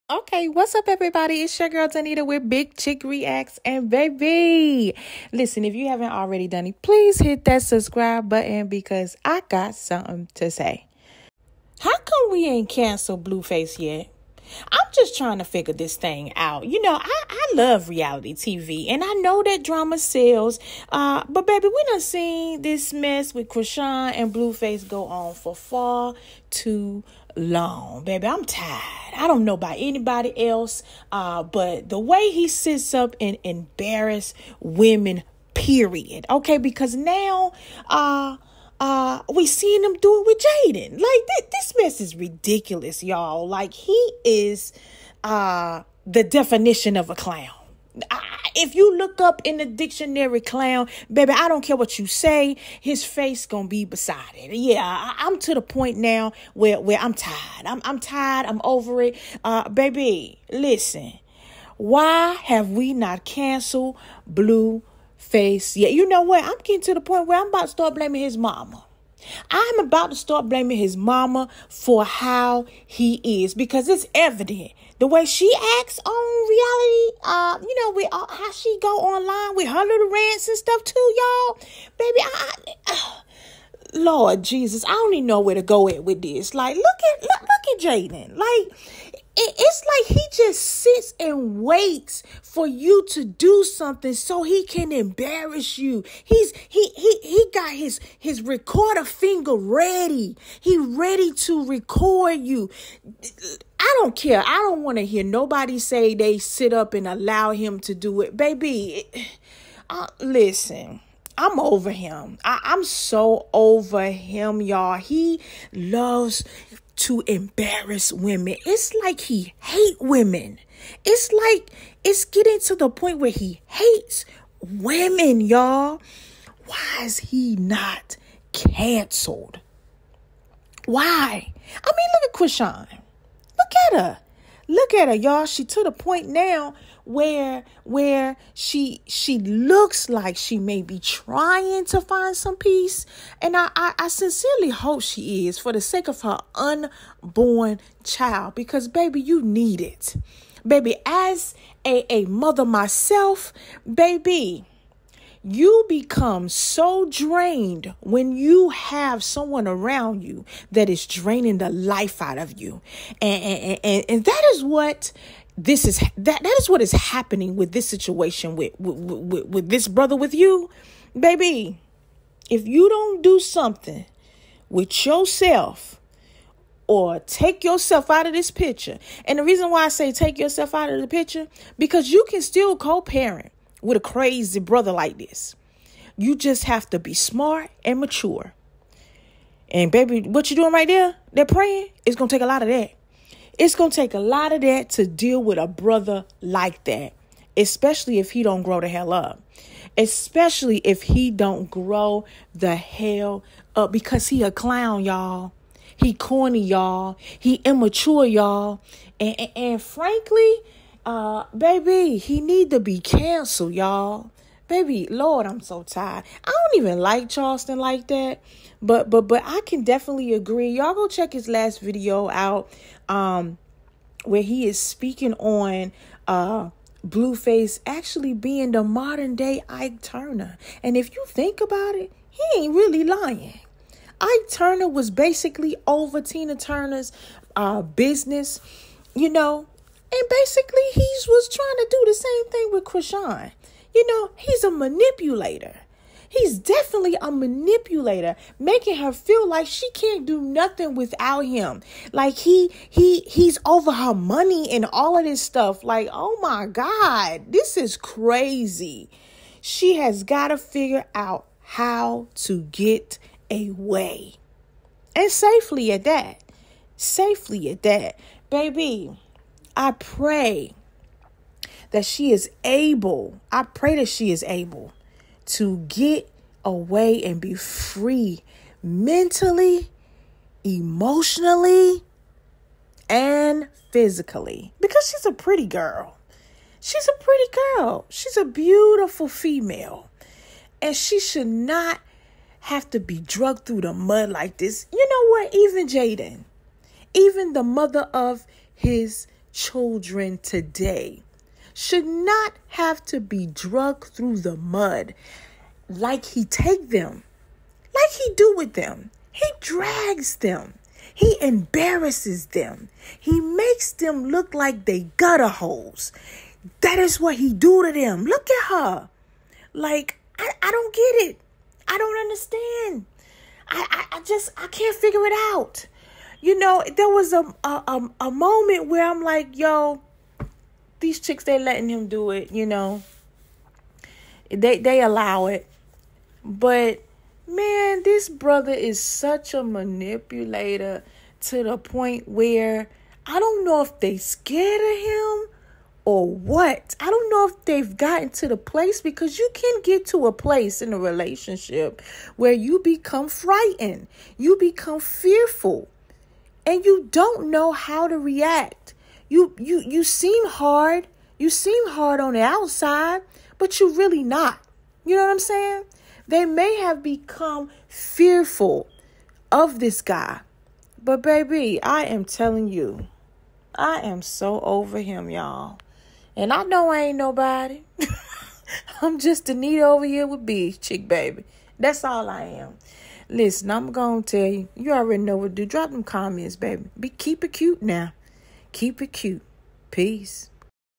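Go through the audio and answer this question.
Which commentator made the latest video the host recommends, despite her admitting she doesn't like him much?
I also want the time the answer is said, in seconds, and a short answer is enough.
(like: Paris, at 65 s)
Charleston, at 217 s.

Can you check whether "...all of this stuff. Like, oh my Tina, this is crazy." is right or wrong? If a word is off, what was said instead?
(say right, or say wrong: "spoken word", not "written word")
wrong: "God", not "Tina".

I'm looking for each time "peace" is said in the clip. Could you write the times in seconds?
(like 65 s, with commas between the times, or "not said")
142 s, 389 s.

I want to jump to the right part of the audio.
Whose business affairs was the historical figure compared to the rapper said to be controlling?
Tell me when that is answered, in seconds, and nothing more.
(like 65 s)
236 s.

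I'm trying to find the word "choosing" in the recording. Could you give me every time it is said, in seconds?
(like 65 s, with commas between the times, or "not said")
not said.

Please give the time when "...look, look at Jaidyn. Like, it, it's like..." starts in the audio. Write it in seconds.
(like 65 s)
87 s.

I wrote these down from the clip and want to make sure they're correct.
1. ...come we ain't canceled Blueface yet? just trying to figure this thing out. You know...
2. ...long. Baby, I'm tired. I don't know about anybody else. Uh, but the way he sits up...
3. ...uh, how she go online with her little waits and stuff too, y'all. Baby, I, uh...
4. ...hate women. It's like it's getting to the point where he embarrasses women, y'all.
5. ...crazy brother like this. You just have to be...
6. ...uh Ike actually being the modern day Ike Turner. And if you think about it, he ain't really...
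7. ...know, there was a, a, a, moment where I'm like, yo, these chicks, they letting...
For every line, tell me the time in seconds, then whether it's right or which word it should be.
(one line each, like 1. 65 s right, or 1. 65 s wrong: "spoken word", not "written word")
1. 11 s right
2. 27 s right
3. 78 s wrong: "rants", not "waits"
4. 119 s wrong: "hates", not "embarrasses"
5. 184 s right
6. 226 s wrong: "Blueface", not "Ike"
7. 326 s right.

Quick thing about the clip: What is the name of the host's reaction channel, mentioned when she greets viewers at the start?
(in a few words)
Big Chick Reacts.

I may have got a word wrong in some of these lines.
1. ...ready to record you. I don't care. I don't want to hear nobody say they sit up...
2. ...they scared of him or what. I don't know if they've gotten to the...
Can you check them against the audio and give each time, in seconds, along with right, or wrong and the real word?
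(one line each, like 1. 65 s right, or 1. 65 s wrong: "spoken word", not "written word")
1. 100 s right
2. 343 s right.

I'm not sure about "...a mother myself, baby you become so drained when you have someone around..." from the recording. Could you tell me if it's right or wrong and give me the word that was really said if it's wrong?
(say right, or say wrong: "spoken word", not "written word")
right.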